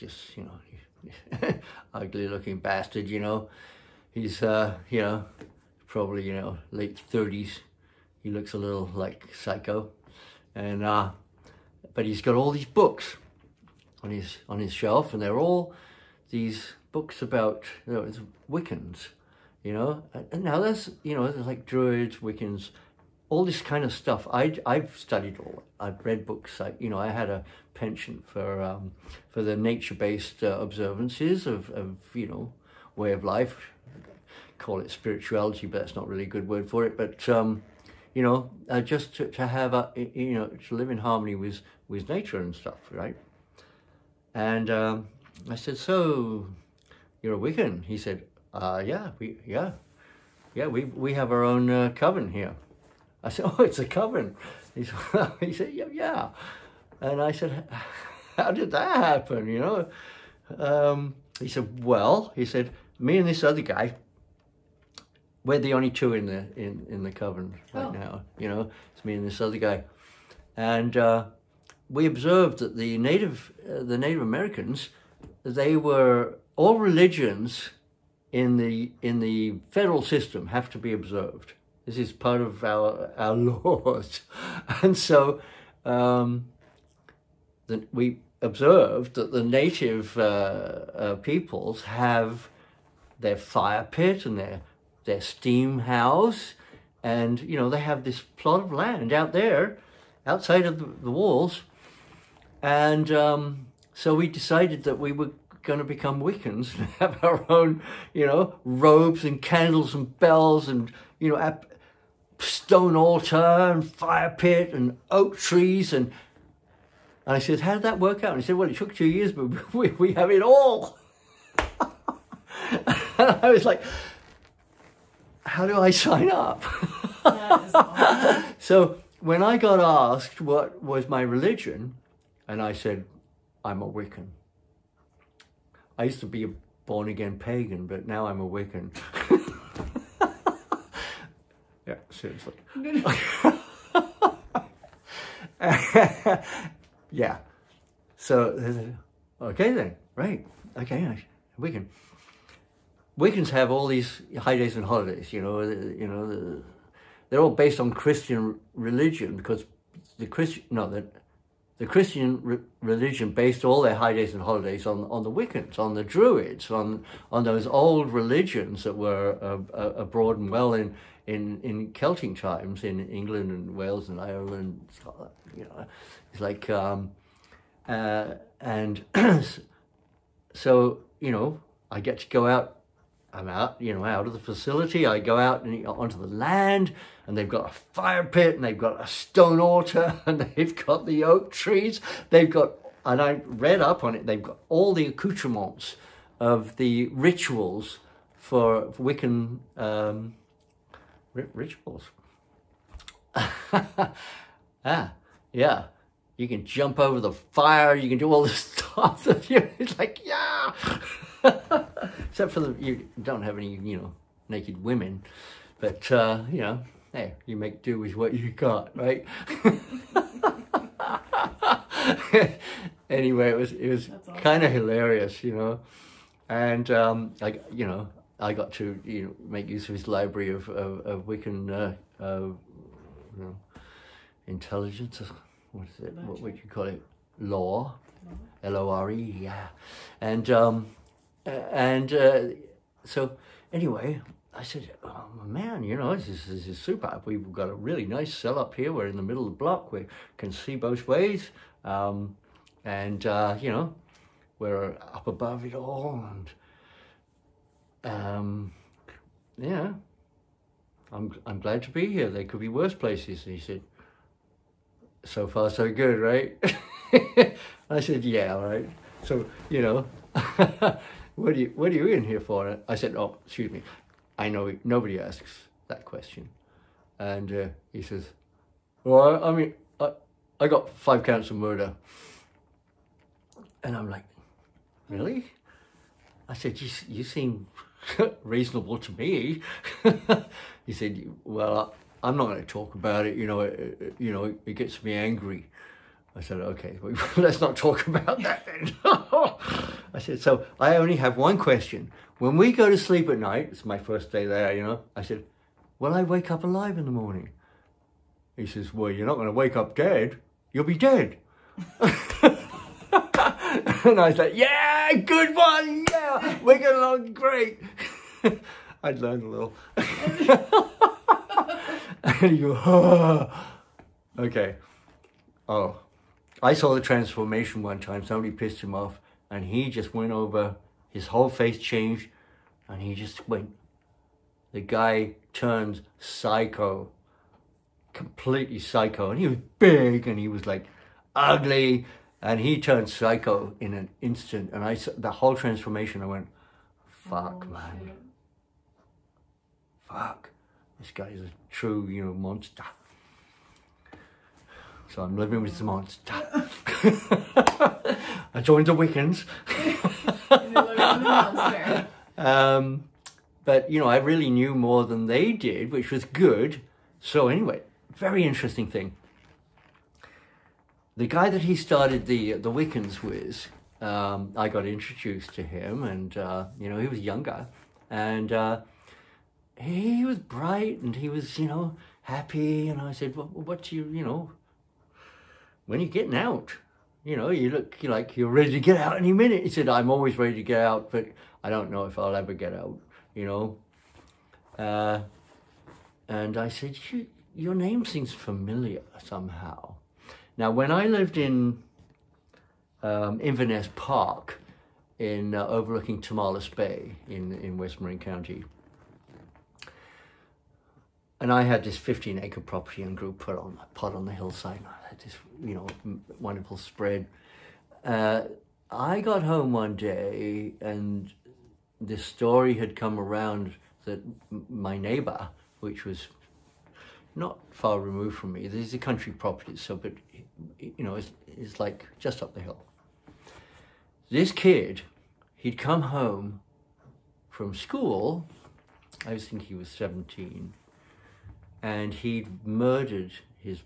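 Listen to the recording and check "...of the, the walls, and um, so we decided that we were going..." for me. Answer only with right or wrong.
right.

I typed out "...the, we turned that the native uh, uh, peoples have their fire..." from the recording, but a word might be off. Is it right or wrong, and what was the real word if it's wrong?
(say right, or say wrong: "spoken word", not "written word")
wrong: "observed", not "turned".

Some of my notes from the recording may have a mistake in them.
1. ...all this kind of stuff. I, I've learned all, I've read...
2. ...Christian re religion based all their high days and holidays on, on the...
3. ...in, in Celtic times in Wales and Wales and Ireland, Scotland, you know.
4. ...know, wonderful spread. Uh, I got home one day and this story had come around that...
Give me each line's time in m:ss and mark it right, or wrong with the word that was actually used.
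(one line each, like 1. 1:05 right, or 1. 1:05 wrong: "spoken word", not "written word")
1. 0:23 wrong: "studied", not "learned"
2. 2:41 right
3. 2:51 wrong: "England", not "Wales"
4. 6:55 right.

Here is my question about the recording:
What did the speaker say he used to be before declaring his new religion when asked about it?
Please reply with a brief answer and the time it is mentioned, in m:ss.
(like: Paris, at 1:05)
Born again pagan, at 2:16.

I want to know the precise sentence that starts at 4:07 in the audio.
We've got a really nice cell up here.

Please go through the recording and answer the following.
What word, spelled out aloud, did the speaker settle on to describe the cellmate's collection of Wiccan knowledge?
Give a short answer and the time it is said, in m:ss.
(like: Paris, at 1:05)
Lore, at 3:58.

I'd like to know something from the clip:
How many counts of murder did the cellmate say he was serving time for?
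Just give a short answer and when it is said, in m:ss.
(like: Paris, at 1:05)
5, at 4:40.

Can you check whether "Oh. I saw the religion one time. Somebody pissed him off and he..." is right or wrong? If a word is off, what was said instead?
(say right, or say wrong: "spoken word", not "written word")
wrong: "transformation", not "religion".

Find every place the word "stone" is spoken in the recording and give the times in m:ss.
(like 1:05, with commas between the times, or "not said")
1:52, 3:09.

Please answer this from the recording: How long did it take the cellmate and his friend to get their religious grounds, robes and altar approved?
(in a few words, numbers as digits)
2 years.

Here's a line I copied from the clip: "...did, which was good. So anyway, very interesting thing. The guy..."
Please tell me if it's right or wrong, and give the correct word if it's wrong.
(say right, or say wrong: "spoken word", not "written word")
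right.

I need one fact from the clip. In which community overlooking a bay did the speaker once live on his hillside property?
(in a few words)
Inverness Park.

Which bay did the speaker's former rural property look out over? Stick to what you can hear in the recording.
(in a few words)
Tomales Bay.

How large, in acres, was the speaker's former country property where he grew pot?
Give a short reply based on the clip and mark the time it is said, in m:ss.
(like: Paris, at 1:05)
15 acres, at 6:51.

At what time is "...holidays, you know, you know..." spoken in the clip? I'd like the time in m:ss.
2:34.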